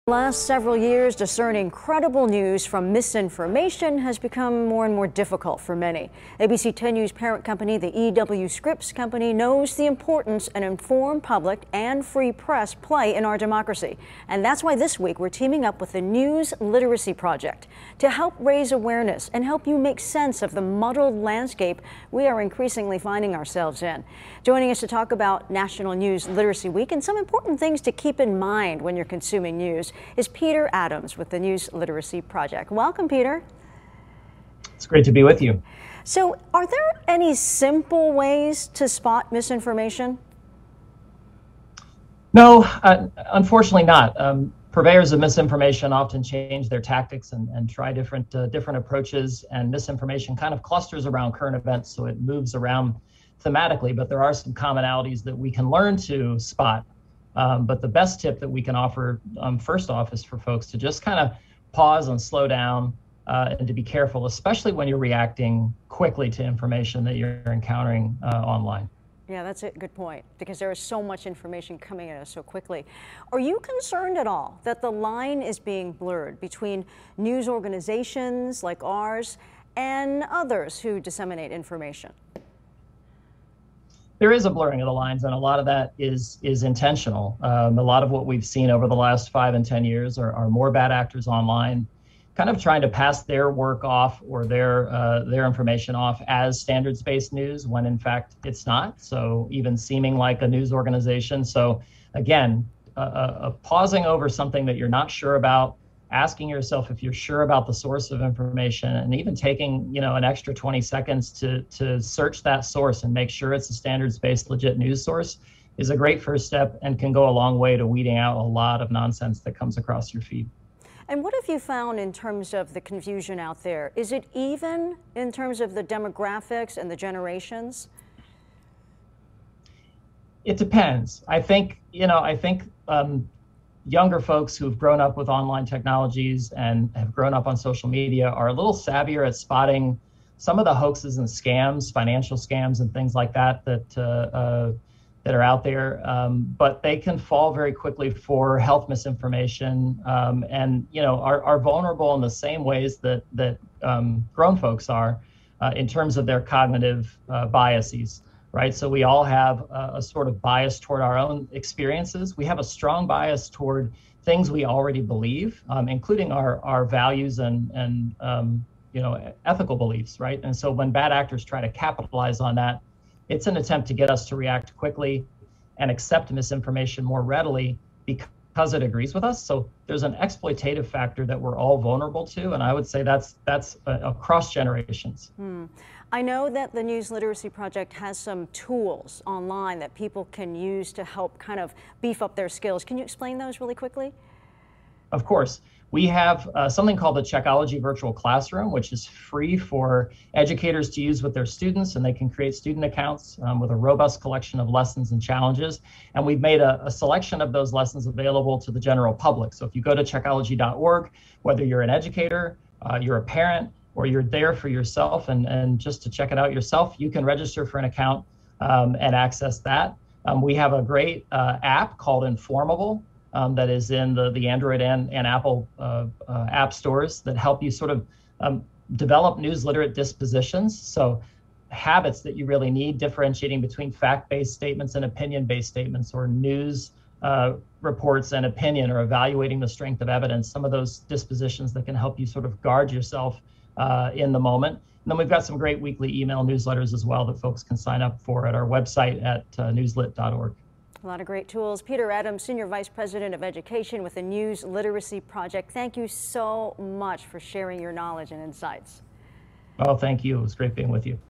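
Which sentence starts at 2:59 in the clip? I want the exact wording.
So there's an exploitative factor that we're all vulnerable to, and I would say that's that's uh, across generations.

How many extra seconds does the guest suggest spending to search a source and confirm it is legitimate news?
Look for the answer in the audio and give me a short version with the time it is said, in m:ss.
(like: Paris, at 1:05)
20, at 1:50.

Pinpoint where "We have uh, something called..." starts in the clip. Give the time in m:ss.
3:15.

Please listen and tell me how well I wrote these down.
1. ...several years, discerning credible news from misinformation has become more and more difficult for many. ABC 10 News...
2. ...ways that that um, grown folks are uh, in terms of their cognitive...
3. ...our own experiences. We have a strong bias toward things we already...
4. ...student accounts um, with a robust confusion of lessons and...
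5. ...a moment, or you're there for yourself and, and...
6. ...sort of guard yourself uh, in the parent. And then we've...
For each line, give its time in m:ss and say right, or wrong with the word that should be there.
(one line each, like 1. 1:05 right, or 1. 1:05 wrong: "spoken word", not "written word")
1. 0:00 right
2. 2:32 right
3. 2:41 right
4. 3:22 wrong: "collection", not "confusion"
5. 3:33 wrong: "parent", not "moment"
6. 4:02 wrong: "moment", not "parent".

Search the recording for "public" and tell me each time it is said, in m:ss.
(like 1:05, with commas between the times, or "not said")
0:11, 3:29.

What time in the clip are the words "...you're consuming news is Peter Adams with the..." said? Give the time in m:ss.
0:28.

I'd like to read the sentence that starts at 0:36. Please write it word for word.
So, are there any simple ways to spot misinformation?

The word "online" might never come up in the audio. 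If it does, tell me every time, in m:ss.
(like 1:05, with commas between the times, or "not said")
1:08, 1:31, 2:15, 3:09.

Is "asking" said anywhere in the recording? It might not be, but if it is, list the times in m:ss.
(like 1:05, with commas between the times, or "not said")
1:46.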